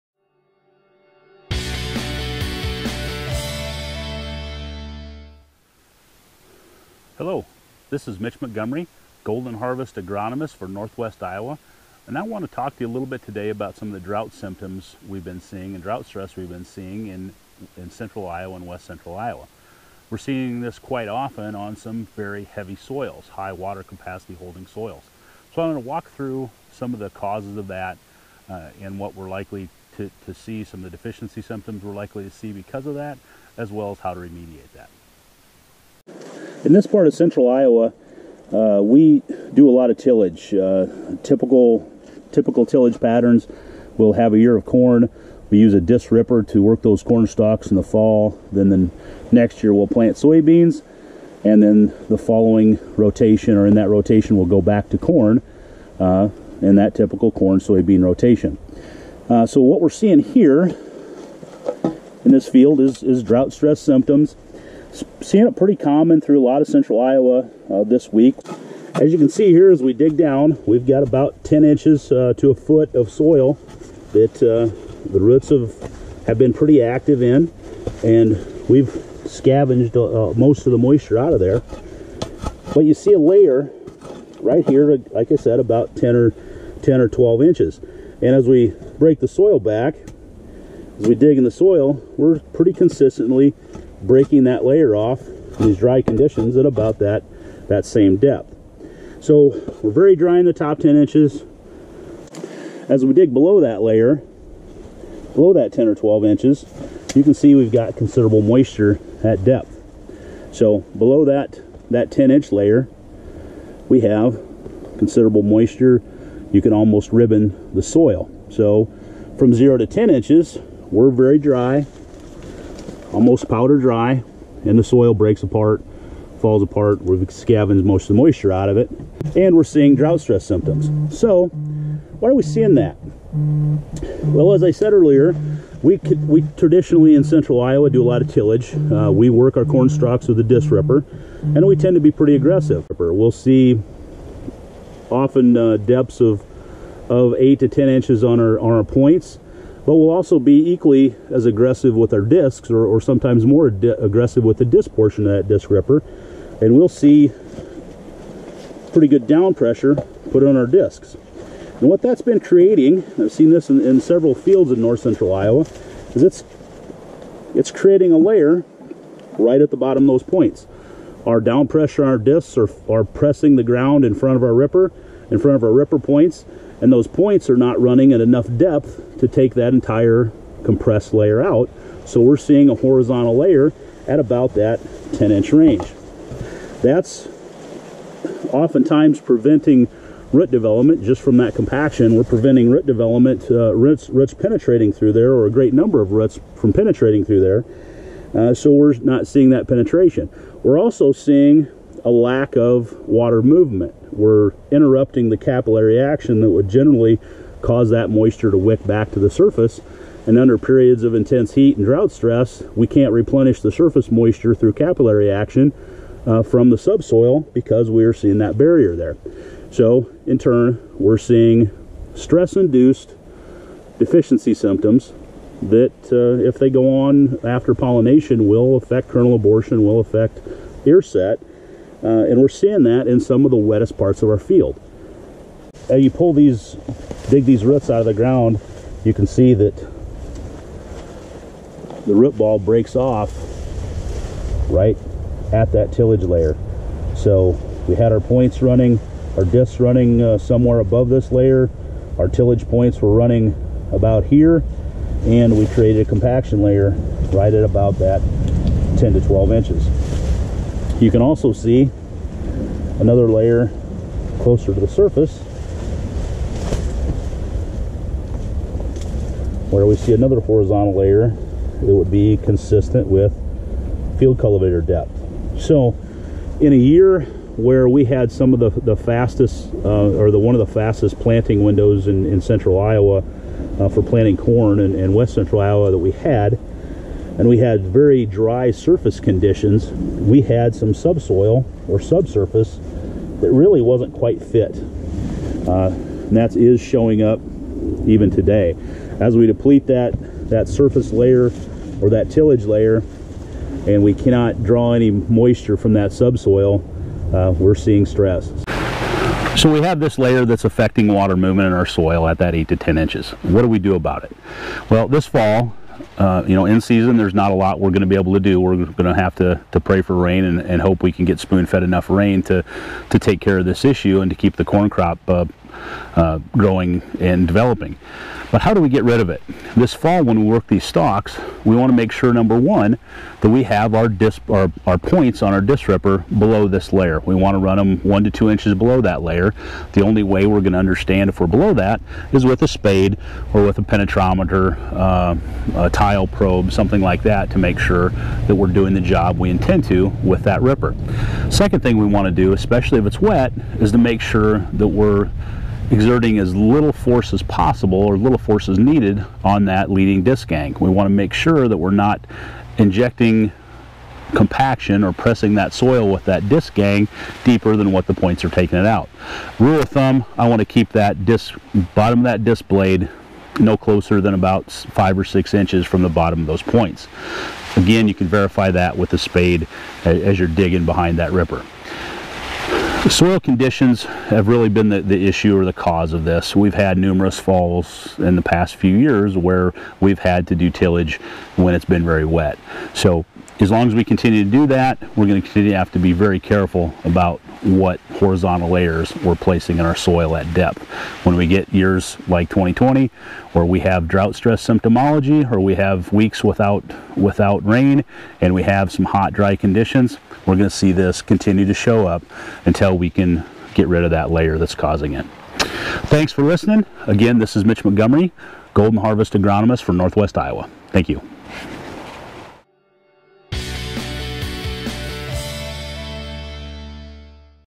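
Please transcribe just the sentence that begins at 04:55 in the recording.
Uh, and that is showing up even today.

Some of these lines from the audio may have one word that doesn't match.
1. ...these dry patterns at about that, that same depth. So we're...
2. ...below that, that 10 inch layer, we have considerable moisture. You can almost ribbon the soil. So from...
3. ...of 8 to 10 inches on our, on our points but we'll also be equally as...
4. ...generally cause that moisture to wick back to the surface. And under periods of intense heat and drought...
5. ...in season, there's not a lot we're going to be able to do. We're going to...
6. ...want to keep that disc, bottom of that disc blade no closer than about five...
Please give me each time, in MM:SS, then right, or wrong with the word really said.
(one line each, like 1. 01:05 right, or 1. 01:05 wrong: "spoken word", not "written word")
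1. 01:35 wrong: "conditions", not "patterns"
2. 01:50 right
3. 02:27 right
4. 03:26 right
5. 05:16 right
6. 06:10 right.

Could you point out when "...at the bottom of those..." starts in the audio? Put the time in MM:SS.
02:49.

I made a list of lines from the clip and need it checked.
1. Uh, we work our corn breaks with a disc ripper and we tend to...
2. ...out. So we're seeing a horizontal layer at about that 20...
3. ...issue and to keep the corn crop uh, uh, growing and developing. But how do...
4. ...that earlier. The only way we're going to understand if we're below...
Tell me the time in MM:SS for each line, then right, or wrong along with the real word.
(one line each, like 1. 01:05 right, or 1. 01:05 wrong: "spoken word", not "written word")
1. 02:18 wrong: "stalks", not "breaks"
2. 03:01 wrong: "10", not "20"
3. 05:23 right
4. 05:39 wrong: "layer", not "earlier".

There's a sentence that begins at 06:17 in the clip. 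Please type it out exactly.
Again, you can verify that with a spade as you're digging behind that ripper.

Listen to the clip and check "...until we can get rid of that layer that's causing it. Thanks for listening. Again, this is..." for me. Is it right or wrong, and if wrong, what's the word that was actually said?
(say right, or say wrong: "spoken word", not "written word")
right.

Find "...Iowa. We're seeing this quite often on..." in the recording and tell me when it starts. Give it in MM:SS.
00:19.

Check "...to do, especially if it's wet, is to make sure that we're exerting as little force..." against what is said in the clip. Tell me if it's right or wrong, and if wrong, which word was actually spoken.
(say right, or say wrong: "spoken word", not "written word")
right.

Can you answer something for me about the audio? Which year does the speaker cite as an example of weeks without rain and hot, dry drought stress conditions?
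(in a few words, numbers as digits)
2020.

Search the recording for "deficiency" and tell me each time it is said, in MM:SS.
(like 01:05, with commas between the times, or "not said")
00:30, 03:43.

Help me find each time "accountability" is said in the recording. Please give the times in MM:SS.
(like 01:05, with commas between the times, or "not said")
not said.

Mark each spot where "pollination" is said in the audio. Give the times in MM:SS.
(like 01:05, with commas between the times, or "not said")
03:47.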